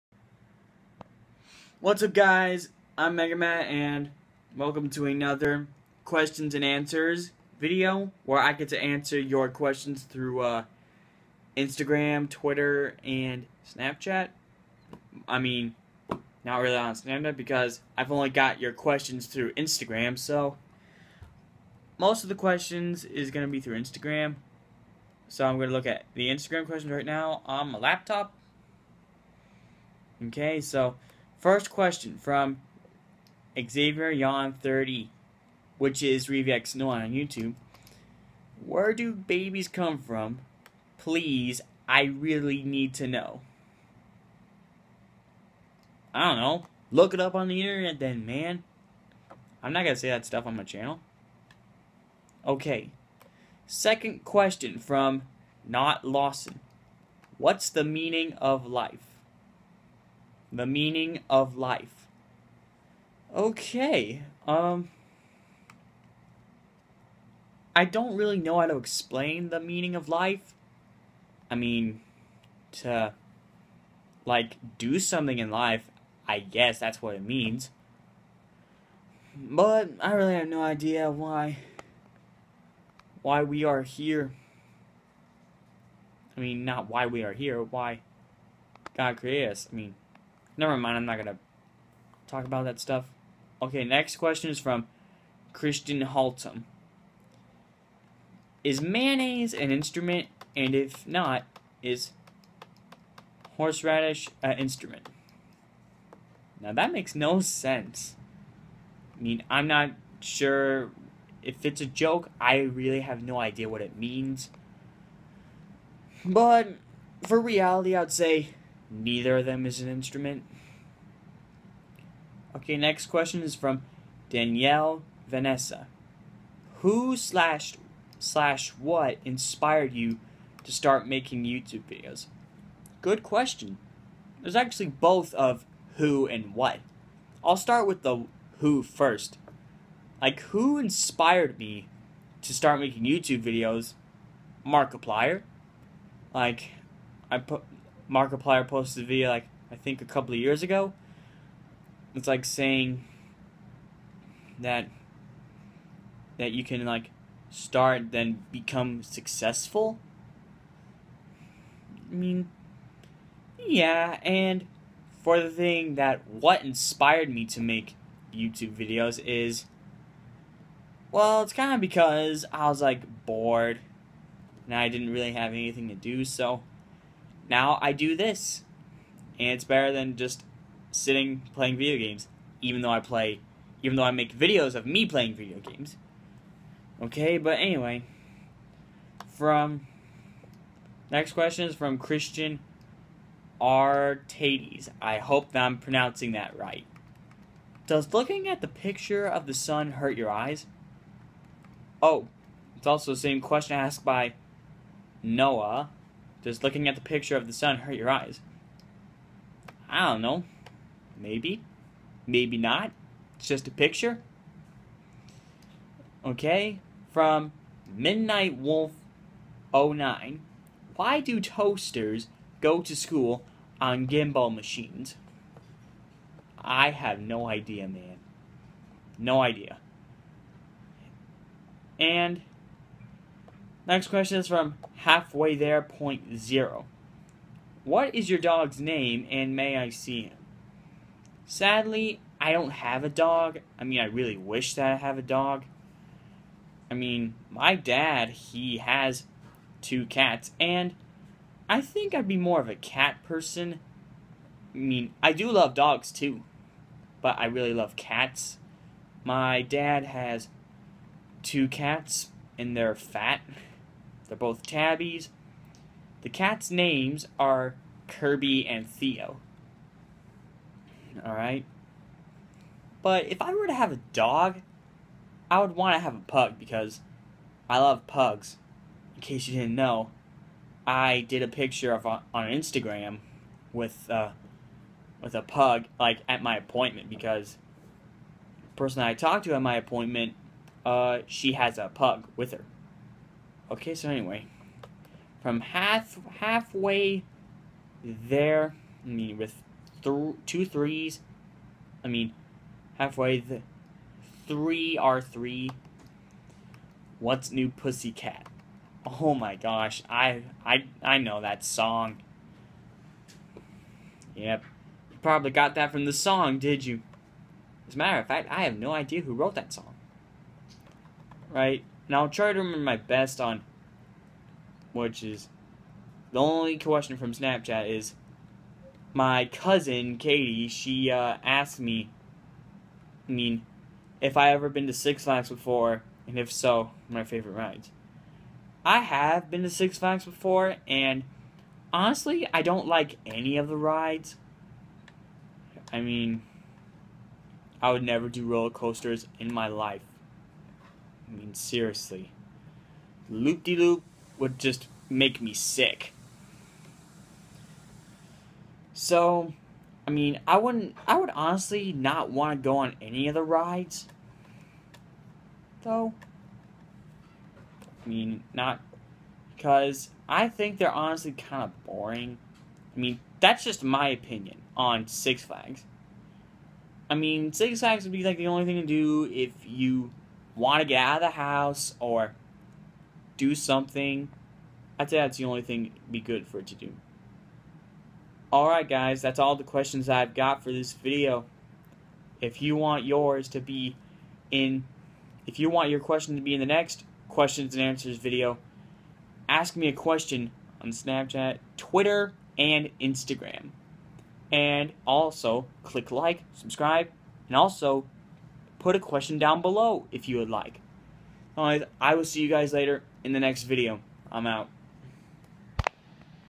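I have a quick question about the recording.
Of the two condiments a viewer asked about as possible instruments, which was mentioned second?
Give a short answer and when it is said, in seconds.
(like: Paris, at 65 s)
Horseradish, at 103 s.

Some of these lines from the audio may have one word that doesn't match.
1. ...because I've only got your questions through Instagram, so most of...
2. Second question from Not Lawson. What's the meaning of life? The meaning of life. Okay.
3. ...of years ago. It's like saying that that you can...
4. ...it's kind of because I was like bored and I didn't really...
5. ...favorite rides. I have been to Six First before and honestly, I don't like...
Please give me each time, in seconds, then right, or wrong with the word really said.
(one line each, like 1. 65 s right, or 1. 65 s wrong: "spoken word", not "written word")
1. 17 s right
2. 53 s right
3. 150 s right
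4. 171 s right
5. 337 s wrong: "Flags", not "First".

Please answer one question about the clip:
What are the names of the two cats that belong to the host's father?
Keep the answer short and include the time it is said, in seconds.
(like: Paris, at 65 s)
Kirby and Theo, at 268 s.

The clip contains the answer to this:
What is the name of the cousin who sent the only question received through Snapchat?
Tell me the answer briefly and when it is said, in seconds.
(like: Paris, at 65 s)
Katie, at 330 s.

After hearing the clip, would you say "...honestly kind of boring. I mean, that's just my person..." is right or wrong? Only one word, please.
wrong.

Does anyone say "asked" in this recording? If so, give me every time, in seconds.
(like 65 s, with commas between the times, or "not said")
203 s, 331 s.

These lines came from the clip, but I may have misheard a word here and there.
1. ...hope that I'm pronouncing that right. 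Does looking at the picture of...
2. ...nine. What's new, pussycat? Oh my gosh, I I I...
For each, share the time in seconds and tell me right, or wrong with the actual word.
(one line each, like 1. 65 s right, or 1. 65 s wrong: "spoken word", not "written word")
1. 195 s right
2. 305 s wrong: "three", not "nine".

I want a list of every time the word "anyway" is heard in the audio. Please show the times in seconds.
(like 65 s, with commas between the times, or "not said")
187 s, 294 s.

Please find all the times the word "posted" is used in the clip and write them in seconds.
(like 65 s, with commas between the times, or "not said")
148 s.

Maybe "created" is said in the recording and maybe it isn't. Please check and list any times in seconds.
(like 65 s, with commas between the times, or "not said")
89 s.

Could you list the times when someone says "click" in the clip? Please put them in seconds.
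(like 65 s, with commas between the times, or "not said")
405 s.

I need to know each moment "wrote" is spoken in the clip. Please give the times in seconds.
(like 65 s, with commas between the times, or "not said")
319 s.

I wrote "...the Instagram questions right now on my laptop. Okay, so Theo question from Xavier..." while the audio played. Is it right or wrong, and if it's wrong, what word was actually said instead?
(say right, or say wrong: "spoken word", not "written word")
wrong: "First", not "Theo".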